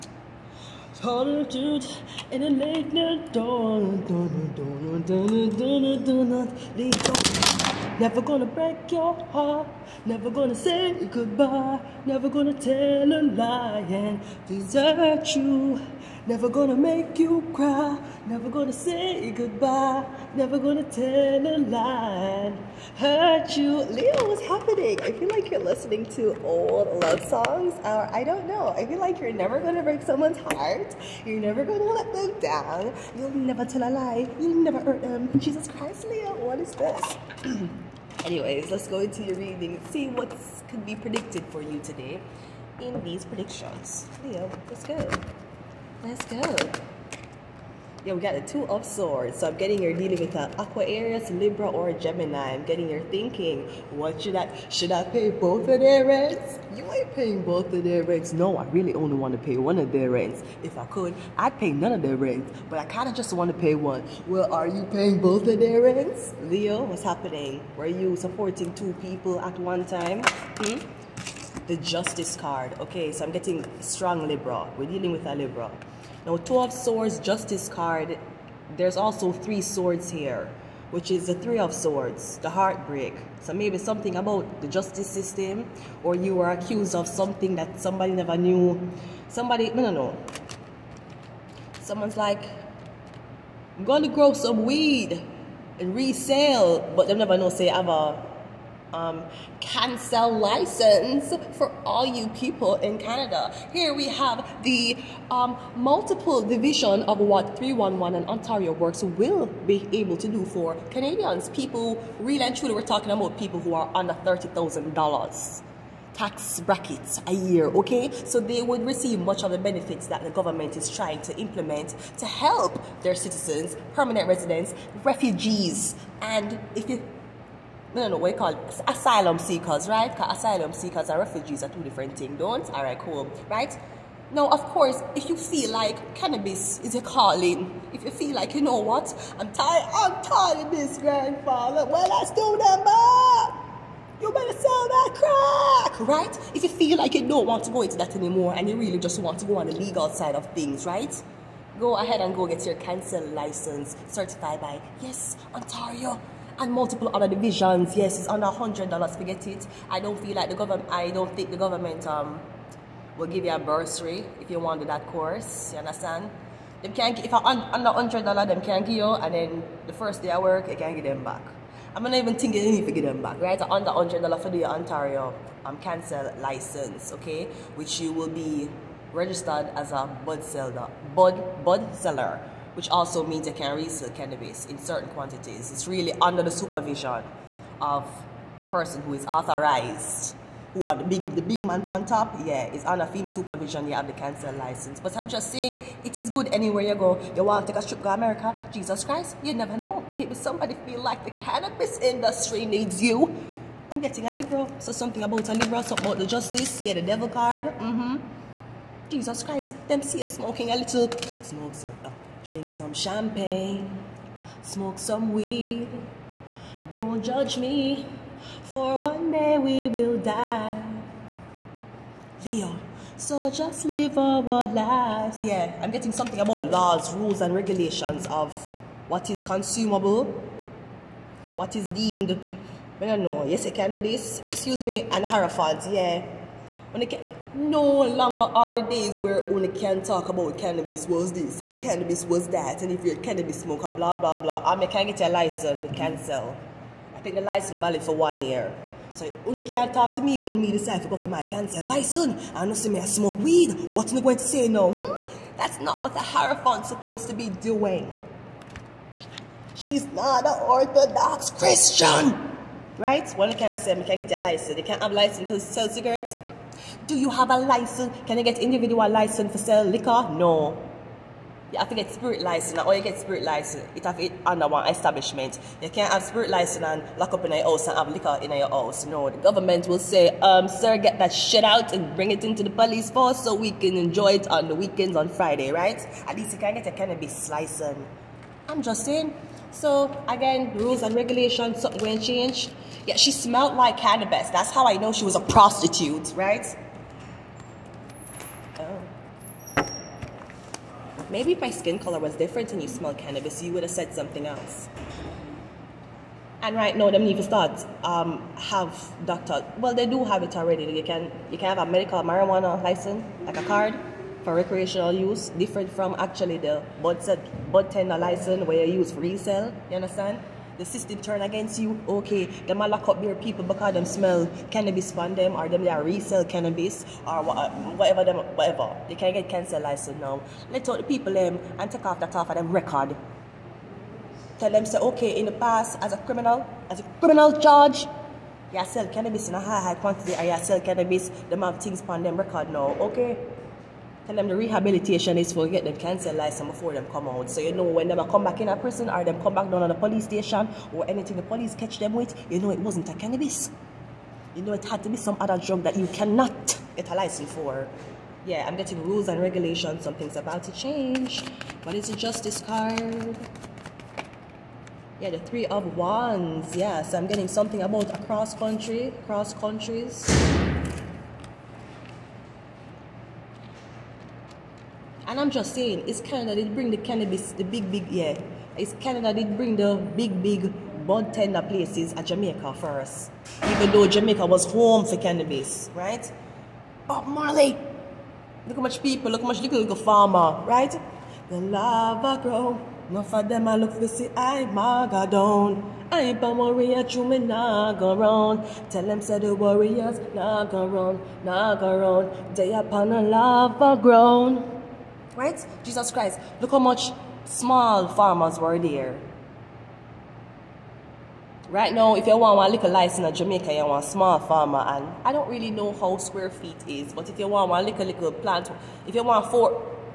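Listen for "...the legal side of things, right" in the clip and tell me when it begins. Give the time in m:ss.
2:29.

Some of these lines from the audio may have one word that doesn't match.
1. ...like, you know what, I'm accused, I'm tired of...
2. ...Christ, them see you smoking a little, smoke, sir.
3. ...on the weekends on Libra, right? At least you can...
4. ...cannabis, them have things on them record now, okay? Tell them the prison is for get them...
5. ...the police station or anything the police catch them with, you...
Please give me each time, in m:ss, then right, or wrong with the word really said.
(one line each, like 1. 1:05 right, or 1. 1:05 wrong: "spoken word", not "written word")
1. 2:18 wrong: "tired", not "accused"
2. 3:29 right
3. 4:44 wrong: "Friday", not "Libra"
4. 5:40 wrong: "rehabilitation", not "prison"
5. 5:49 right.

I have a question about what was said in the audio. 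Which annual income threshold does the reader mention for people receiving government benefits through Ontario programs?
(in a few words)
$30,000.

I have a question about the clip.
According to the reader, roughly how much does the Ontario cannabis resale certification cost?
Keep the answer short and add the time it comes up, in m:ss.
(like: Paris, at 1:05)
Under 100 dollars, at 2:38.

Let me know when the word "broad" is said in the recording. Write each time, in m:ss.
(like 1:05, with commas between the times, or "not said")
not said.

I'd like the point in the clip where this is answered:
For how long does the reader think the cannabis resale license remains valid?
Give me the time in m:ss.
4:08.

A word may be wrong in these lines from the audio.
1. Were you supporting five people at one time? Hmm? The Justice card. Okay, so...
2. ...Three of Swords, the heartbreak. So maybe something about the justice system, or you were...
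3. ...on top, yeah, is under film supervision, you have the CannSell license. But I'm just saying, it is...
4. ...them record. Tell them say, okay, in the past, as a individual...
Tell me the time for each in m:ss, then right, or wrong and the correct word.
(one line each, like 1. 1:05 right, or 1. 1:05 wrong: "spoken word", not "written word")
1. 1:07 wrong: "two", not "five"
2. 1:21 right
3. 3:11 right
4. 5:32 wrong: "criminal", not "individual".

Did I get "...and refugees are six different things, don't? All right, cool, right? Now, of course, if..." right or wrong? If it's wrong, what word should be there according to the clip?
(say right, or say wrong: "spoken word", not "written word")
wrong: "two", not "six".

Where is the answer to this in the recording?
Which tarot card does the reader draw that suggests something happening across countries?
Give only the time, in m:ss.
6:05.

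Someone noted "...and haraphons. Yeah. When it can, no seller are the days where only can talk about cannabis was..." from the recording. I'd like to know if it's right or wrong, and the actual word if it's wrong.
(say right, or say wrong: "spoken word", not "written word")
wrong: "longer", not "seller".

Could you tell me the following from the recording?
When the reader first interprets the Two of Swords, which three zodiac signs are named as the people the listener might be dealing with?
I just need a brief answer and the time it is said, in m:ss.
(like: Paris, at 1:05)
Aquarius, Libra, or Gemini, at 0:50.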